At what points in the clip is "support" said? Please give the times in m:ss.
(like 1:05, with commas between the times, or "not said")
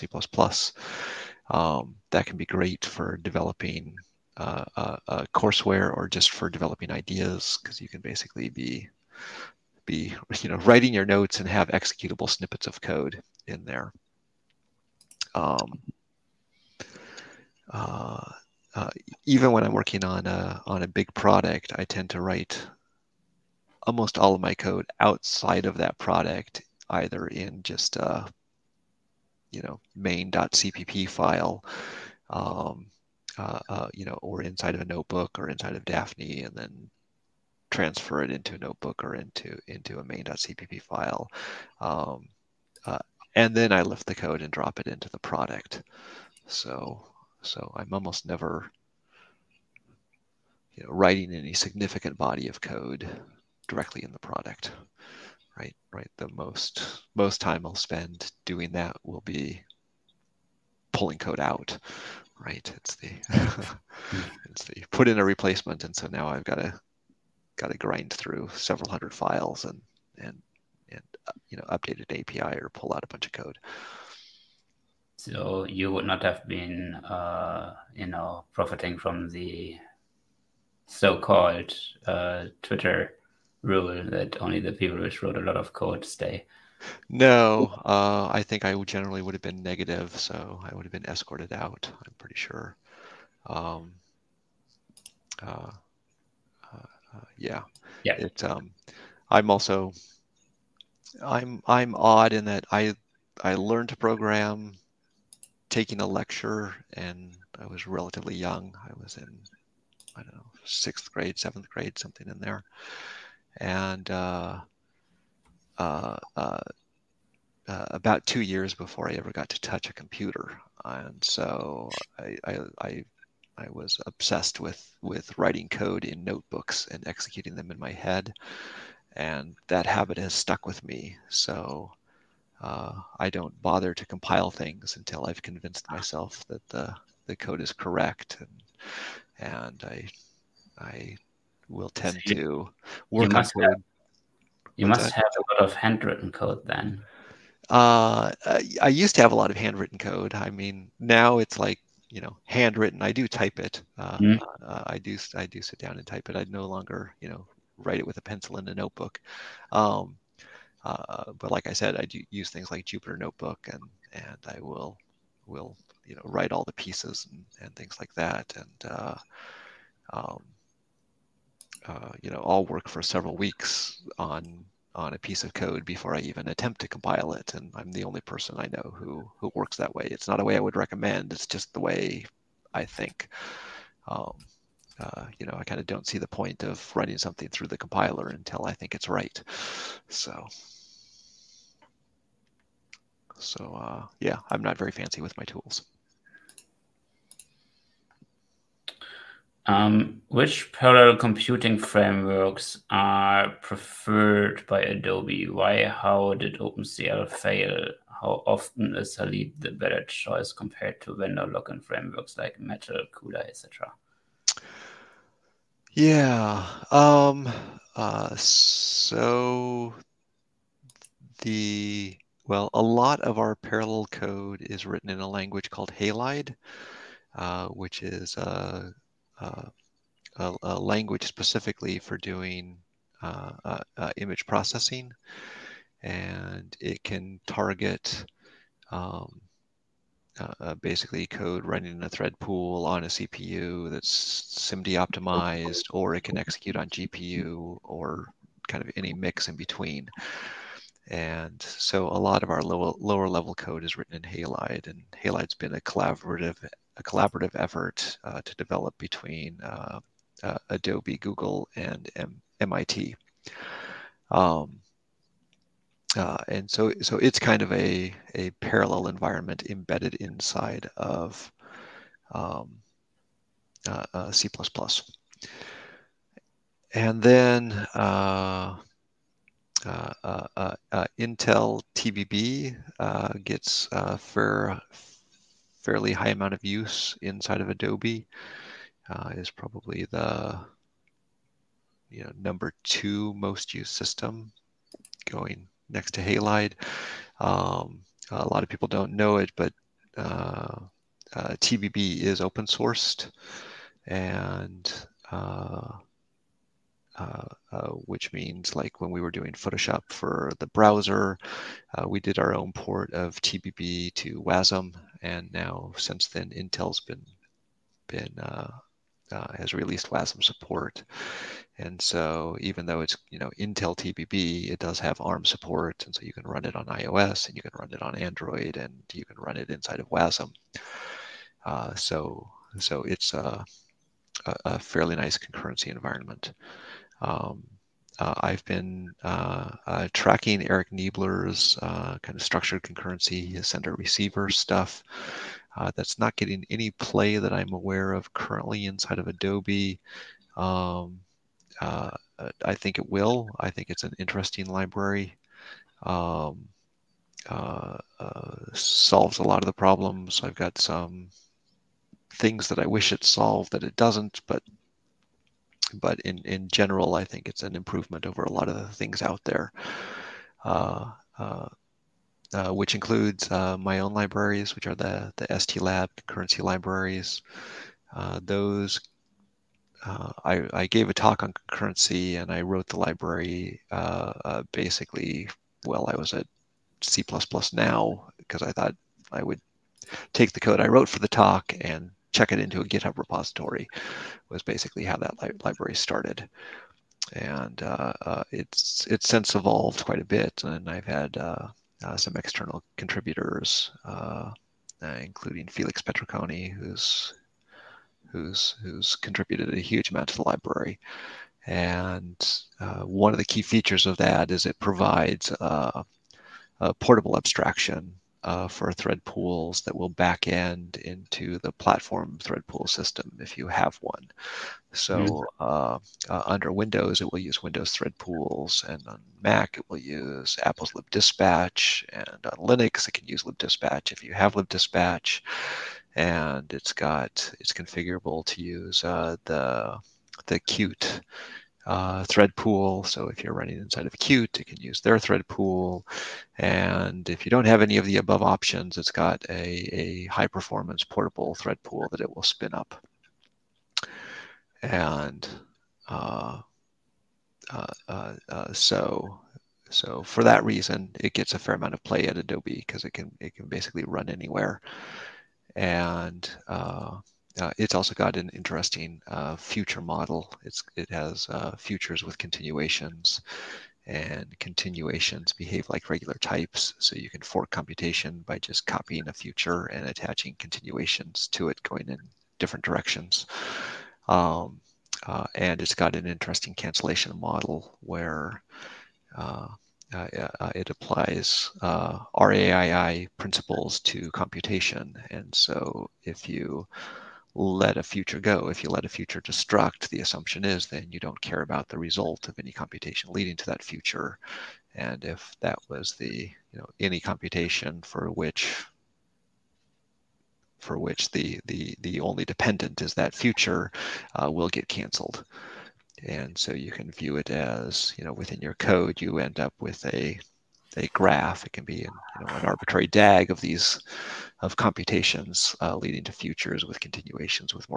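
5:20, 5:25.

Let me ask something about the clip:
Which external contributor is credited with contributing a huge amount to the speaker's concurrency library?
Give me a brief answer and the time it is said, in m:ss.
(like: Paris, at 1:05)
Felix Petriconi, at 6:45.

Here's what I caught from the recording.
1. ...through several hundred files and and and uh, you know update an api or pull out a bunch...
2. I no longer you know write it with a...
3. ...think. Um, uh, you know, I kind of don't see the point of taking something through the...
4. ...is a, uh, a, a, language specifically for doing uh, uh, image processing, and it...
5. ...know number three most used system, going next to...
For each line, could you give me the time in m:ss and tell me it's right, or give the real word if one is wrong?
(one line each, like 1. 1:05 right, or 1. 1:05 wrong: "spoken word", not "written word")
1. 1:08 right
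2. 2:36 right
3. 3:02 wrong: "running", not "taking"
4. 3:48 right
5. 4:52 wrong: "two", not "three".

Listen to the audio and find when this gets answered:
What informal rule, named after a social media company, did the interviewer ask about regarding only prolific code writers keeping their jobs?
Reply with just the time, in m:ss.
1:22.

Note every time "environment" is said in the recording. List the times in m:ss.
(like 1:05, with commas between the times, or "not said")
4:29, 5:35.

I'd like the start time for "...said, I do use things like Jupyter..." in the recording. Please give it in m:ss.
2:41.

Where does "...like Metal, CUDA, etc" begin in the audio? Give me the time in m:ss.
3:32.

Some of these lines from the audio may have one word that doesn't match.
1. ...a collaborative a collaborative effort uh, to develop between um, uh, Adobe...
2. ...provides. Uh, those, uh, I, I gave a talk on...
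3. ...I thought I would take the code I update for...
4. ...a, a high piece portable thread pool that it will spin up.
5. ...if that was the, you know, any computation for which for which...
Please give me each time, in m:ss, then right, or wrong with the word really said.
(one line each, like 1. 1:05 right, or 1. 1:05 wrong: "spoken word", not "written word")
1. 4:15 right
2. 6:16 wrong: "libraries", not "provides"
3. 6:28 wrong: "wrote", not "update"
4. 7:29 wrong: "performance", not "piece"
5. 8:25 right.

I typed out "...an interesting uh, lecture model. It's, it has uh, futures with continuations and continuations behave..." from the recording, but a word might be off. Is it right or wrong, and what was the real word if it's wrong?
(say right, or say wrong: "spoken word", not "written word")
wrong: "future", not "lecture".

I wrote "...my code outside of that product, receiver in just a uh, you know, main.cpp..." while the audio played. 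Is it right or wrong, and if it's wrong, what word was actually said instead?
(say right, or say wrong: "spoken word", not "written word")
wrong: "either", not "receiver".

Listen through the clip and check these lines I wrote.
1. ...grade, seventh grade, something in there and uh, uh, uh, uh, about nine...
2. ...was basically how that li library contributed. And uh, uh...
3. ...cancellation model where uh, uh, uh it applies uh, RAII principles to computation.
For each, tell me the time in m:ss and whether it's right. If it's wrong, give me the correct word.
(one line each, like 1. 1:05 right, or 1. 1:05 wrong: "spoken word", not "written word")
1. 1:51 wrong: "two", not "nine"
2. 6:34 wrong: "started", not "contributed"
3. 8:06 right.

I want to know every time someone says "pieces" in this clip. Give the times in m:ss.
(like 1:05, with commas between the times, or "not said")
2:46, 2:55.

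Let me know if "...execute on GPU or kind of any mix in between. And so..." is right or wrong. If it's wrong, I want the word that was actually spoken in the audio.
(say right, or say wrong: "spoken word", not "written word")
right.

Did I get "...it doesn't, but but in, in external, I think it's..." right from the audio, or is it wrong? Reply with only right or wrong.
wrong.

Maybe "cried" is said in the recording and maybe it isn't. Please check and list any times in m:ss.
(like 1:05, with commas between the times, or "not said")
not said.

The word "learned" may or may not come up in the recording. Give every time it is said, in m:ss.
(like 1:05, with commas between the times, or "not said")
1:43.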